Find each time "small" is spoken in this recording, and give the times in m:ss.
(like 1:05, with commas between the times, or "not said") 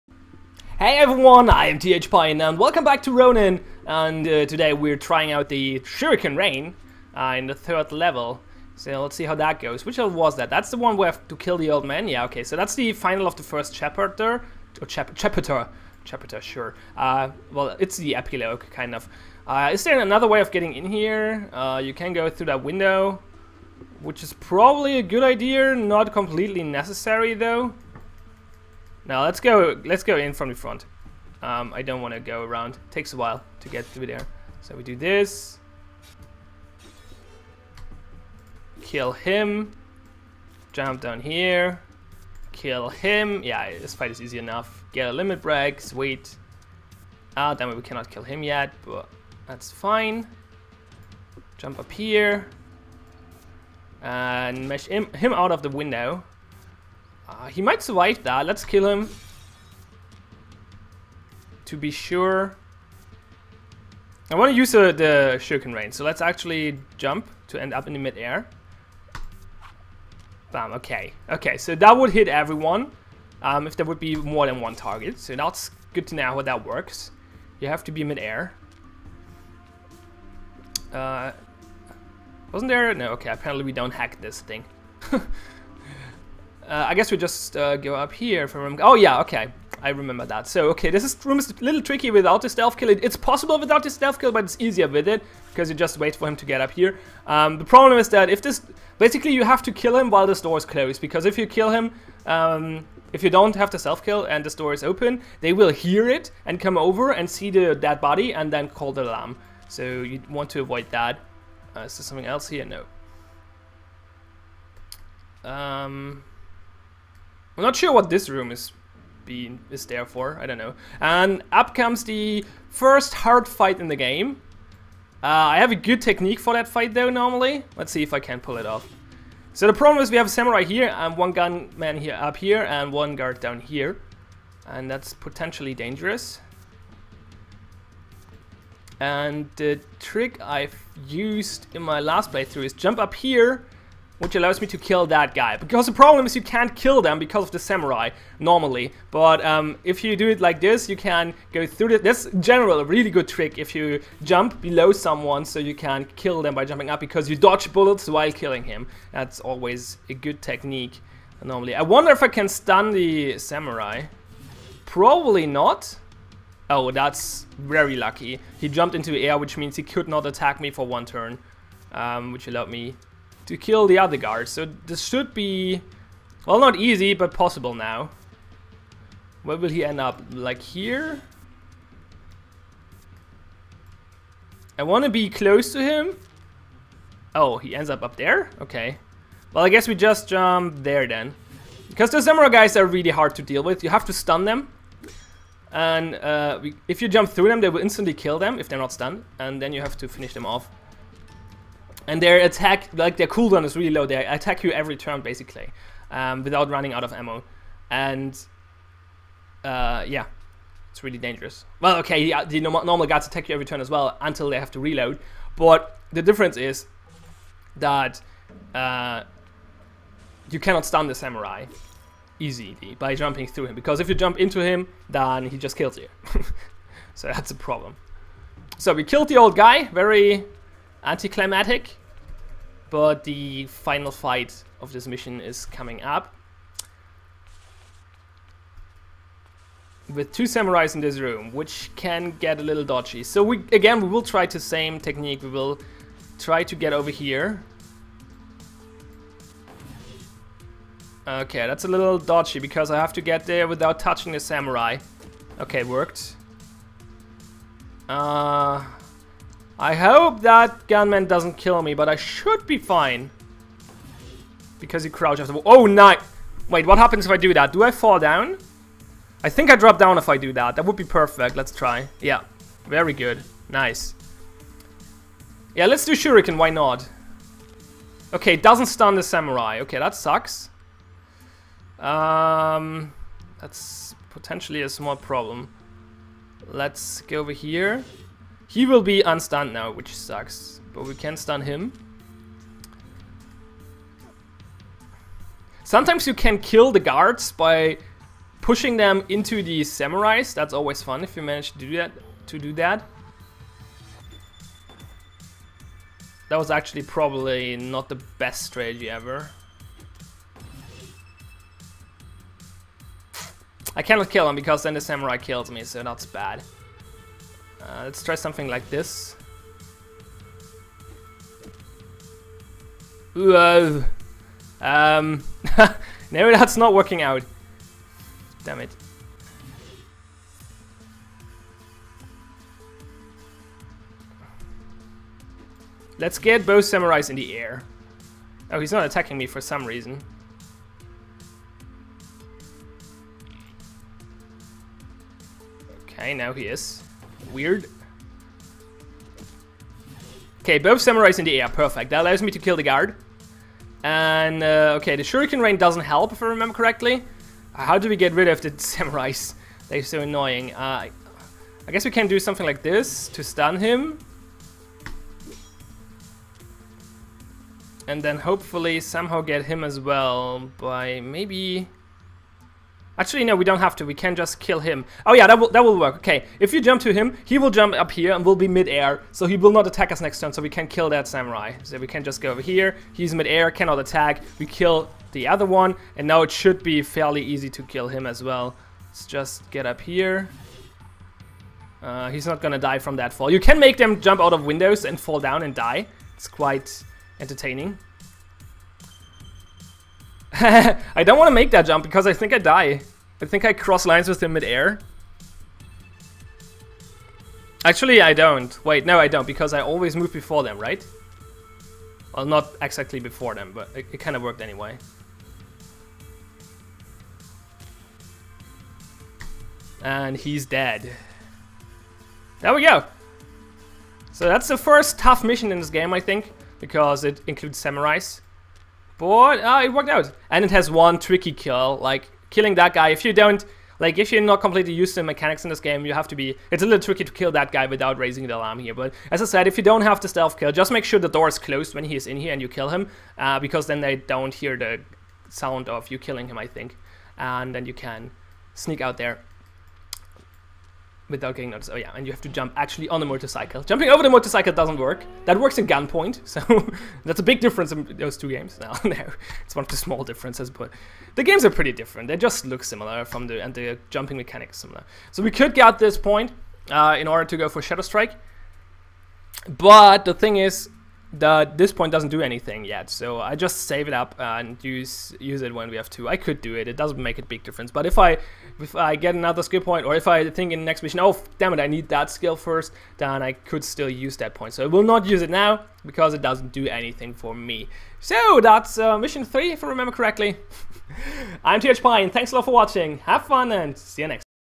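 4:44, 7:39.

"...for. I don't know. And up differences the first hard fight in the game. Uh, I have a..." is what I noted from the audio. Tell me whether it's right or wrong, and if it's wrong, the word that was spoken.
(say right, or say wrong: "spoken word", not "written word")
wrong: "comes", not "differences".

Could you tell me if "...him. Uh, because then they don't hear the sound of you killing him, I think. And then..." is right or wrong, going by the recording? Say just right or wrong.
right.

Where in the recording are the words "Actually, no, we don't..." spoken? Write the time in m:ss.
6:13.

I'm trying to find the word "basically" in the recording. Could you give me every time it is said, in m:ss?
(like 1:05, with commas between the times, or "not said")
1:38, 3:25.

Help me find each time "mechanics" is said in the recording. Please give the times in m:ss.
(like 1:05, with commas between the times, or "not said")
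7:15, 7:44.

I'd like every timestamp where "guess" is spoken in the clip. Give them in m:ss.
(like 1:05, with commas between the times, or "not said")
1:26, 3:09, 6:01.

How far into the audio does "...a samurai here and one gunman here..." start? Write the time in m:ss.
2:10.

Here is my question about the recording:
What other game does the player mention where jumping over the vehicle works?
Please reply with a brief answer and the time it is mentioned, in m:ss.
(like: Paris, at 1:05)
Gunpoint, at 7:35.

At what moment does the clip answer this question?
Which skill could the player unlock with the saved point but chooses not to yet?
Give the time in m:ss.
7:47.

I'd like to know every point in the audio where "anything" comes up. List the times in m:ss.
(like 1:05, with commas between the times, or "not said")
7:52, 8:06.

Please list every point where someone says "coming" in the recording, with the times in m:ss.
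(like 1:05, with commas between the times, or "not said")
3:55.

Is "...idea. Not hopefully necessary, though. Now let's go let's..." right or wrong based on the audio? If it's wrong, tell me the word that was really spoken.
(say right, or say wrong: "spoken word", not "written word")
wrong: "completely", not "hopefully".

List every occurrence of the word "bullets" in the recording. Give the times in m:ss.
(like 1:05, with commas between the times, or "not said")
2:37.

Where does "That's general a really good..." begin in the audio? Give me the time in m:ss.
2:32.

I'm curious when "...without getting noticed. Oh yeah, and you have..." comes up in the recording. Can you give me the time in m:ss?
7:31.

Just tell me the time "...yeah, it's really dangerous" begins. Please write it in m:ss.
3:30.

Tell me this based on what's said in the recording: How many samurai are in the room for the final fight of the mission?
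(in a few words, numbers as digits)
2.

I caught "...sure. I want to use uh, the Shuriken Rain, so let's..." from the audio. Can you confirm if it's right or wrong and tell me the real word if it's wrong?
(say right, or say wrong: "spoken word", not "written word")
right.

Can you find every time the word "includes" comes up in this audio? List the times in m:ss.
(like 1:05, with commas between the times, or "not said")
7:07.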